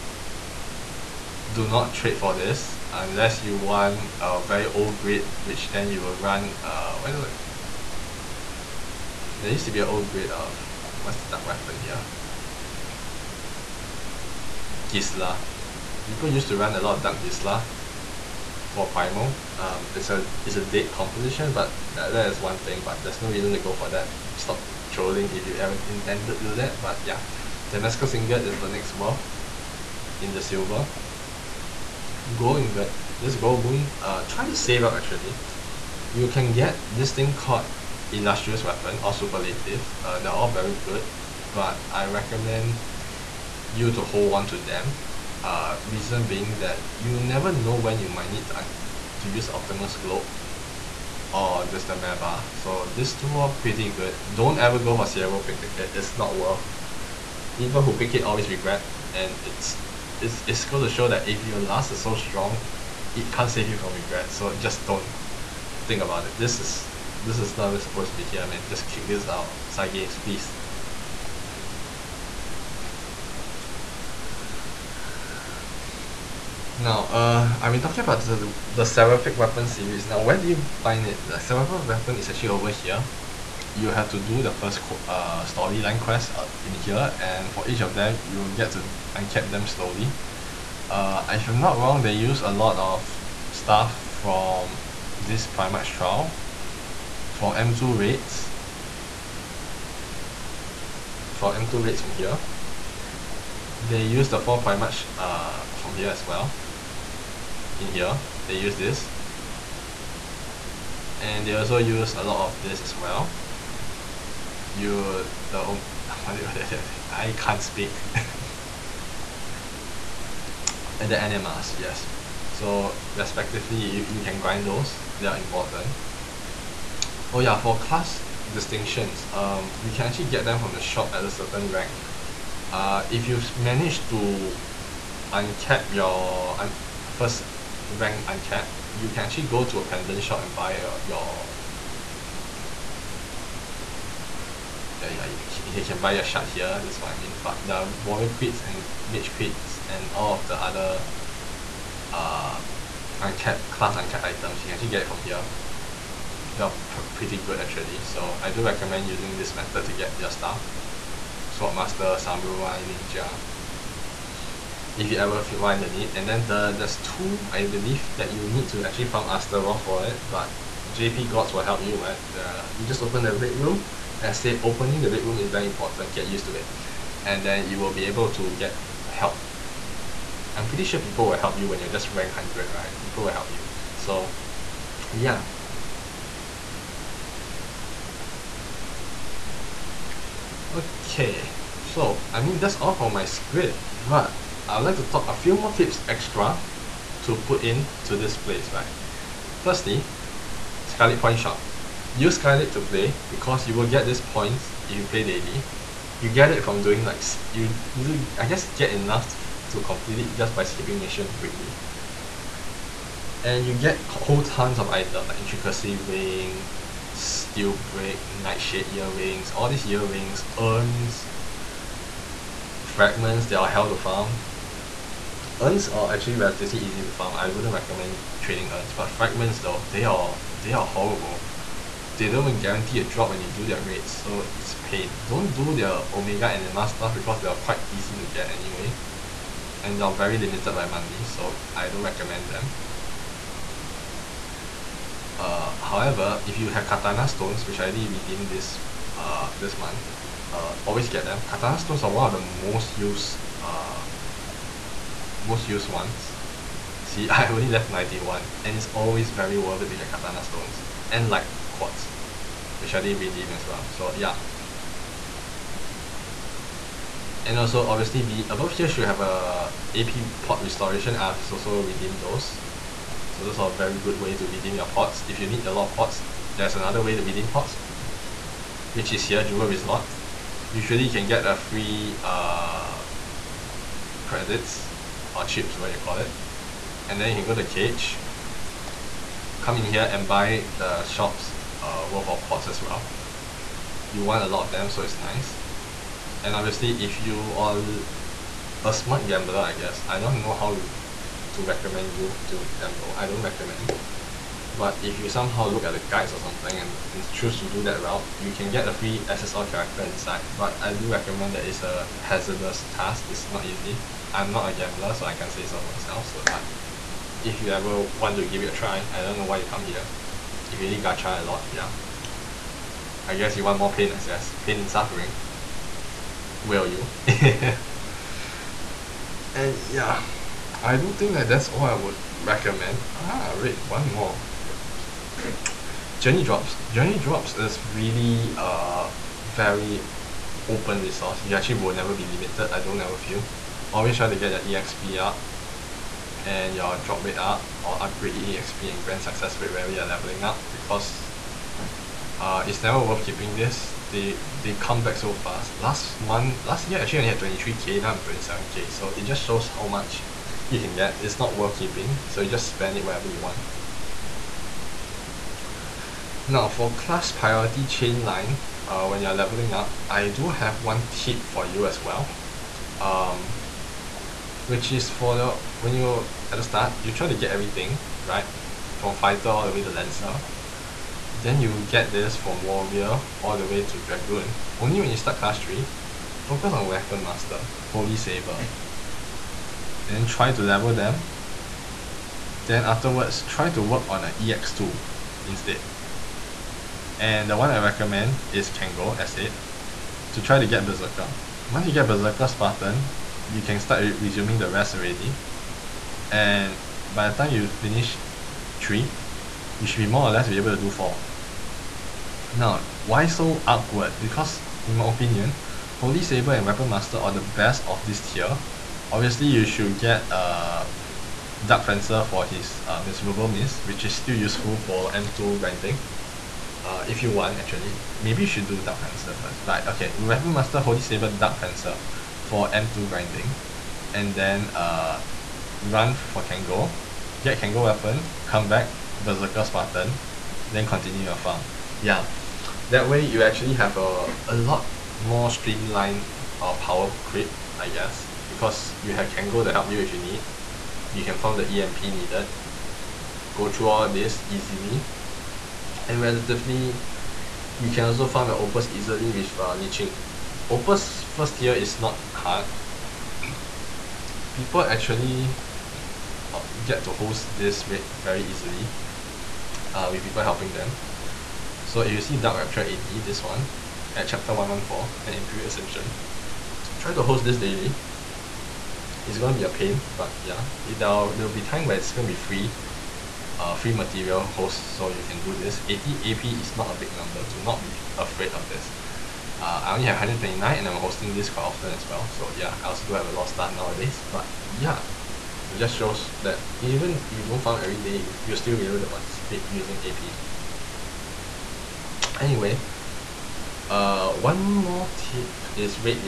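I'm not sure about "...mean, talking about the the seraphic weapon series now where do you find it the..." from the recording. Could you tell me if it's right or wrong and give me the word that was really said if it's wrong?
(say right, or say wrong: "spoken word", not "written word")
right.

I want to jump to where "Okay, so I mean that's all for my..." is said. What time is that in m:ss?
3:10.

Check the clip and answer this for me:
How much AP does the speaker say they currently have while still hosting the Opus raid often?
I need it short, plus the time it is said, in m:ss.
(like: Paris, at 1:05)
129, at 8:10.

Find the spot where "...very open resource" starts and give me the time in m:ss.
5:39.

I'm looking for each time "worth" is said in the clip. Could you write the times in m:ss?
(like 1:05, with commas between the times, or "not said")
0:28, 0:56, 4:19, 4:52, 5:53, 6:01.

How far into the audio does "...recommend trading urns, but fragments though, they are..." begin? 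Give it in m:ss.
3:47.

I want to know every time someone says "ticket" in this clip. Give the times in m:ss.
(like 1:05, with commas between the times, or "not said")
0:55.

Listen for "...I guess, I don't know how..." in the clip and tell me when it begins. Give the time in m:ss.
4:59.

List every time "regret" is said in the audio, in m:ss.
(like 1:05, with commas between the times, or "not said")
0:58, 1:03.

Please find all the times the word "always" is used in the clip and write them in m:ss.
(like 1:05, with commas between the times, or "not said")
0:58, 4:10, 4:18, 5:43.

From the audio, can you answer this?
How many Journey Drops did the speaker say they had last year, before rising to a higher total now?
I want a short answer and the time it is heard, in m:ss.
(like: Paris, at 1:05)
23k, at 5:57.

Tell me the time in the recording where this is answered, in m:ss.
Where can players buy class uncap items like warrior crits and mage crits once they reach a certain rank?
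2:19.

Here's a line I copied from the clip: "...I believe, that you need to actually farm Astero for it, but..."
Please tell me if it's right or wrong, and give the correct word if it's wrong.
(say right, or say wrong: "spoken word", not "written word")
right.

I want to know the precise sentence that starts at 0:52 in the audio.
So these two are pretty good.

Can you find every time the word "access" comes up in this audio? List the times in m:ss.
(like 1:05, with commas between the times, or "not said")
5:24.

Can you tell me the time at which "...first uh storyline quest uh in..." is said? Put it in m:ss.
1:24.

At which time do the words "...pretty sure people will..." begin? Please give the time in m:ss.
3:00.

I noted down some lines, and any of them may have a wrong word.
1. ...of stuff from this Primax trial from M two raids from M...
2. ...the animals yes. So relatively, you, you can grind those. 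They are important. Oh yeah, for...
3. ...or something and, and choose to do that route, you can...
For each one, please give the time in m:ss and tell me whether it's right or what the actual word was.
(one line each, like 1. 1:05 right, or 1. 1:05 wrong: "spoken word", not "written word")
1. 1:32 right
2. 2:01 wrong: "respectively", not "relatively"
3. 5:06 right.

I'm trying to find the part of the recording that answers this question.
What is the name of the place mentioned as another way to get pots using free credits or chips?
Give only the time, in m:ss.
4:39.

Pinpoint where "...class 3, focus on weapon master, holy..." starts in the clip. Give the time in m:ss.
6:25.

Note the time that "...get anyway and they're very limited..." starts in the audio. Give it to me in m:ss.
3:58.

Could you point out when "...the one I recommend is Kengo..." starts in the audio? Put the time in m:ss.
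6:37.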